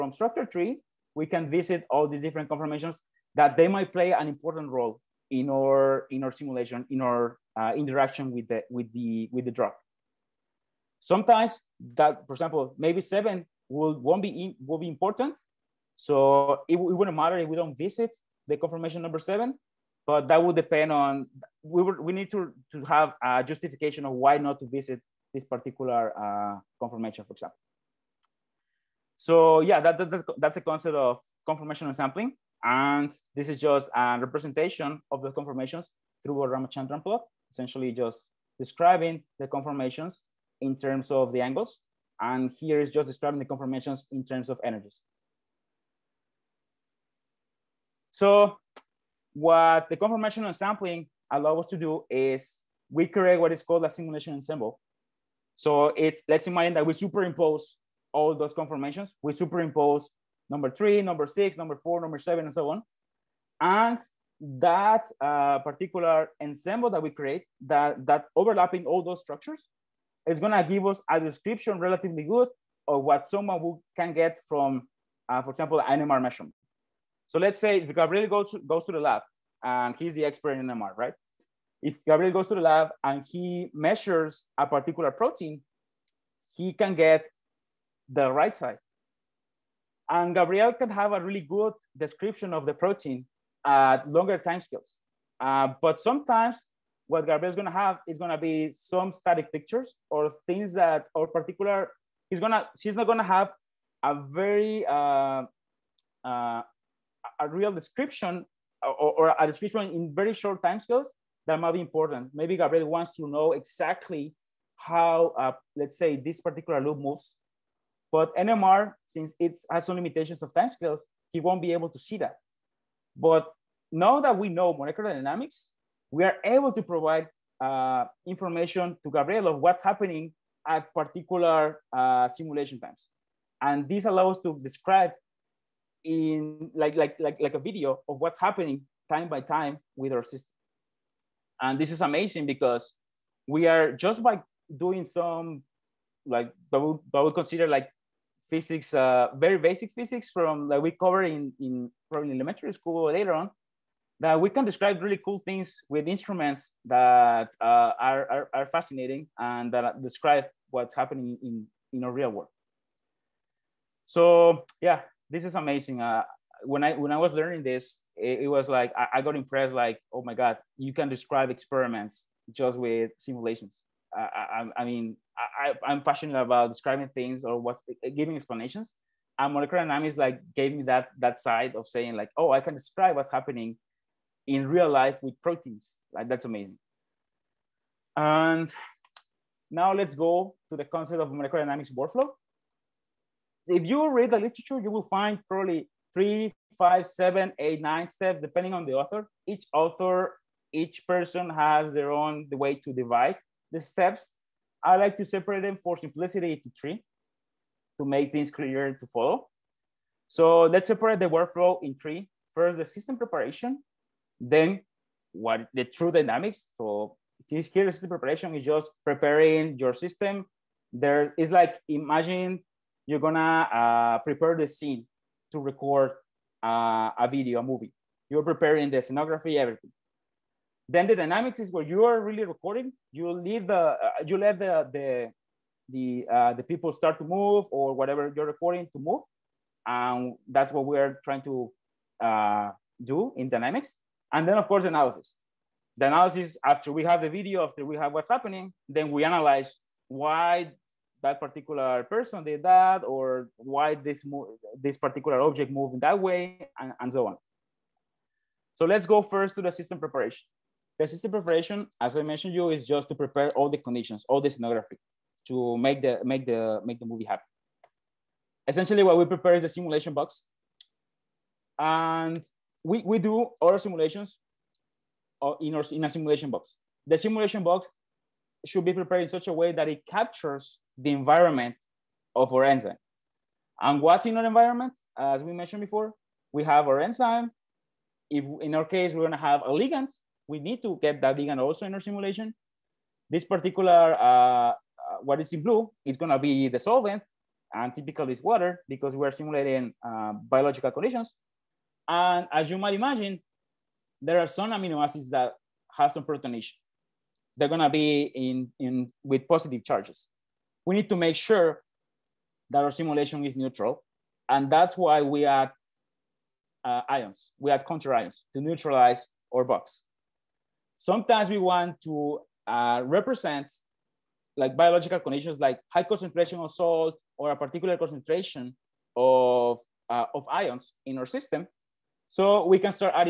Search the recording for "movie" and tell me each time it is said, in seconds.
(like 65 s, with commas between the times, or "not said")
227 s, 267 s.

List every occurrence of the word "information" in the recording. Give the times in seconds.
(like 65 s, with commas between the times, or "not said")
128 s.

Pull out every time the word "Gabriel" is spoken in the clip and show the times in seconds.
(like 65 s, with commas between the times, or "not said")
77 s, 82 s, 90 s, 97 s, 112 s, 129 s.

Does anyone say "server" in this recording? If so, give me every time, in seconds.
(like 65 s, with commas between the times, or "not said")
not said.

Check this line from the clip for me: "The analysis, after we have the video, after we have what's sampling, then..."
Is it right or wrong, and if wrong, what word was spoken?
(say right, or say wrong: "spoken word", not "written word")
wrong: "happening", not "sampling".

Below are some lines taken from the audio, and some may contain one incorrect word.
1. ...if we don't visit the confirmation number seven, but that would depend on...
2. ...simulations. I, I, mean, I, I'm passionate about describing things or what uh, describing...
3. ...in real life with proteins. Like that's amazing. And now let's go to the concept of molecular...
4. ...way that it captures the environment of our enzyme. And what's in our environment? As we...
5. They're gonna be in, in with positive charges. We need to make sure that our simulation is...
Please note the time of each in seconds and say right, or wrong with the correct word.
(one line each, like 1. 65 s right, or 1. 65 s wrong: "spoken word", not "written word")
1. 17 s right
2. 173 s wrong: "giving", not "describing"
3. 184 s right
4. 279 s right
5. 307 s right.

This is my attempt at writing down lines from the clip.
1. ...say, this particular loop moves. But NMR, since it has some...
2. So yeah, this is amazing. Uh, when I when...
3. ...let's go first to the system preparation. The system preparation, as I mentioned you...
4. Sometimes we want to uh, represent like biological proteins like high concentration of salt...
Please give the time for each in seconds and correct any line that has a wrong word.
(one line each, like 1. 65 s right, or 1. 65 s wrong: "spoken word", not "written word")
1. 115 s right
2. 164 s right
3. 258 s right
4. 320 s wrong: "conditions", not "proteins".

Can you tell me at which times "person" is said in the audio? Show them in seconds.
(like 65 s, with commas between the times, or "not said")
201 s, 252 s.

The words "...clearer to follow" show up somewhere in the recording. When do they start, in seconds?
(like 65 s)
208 s.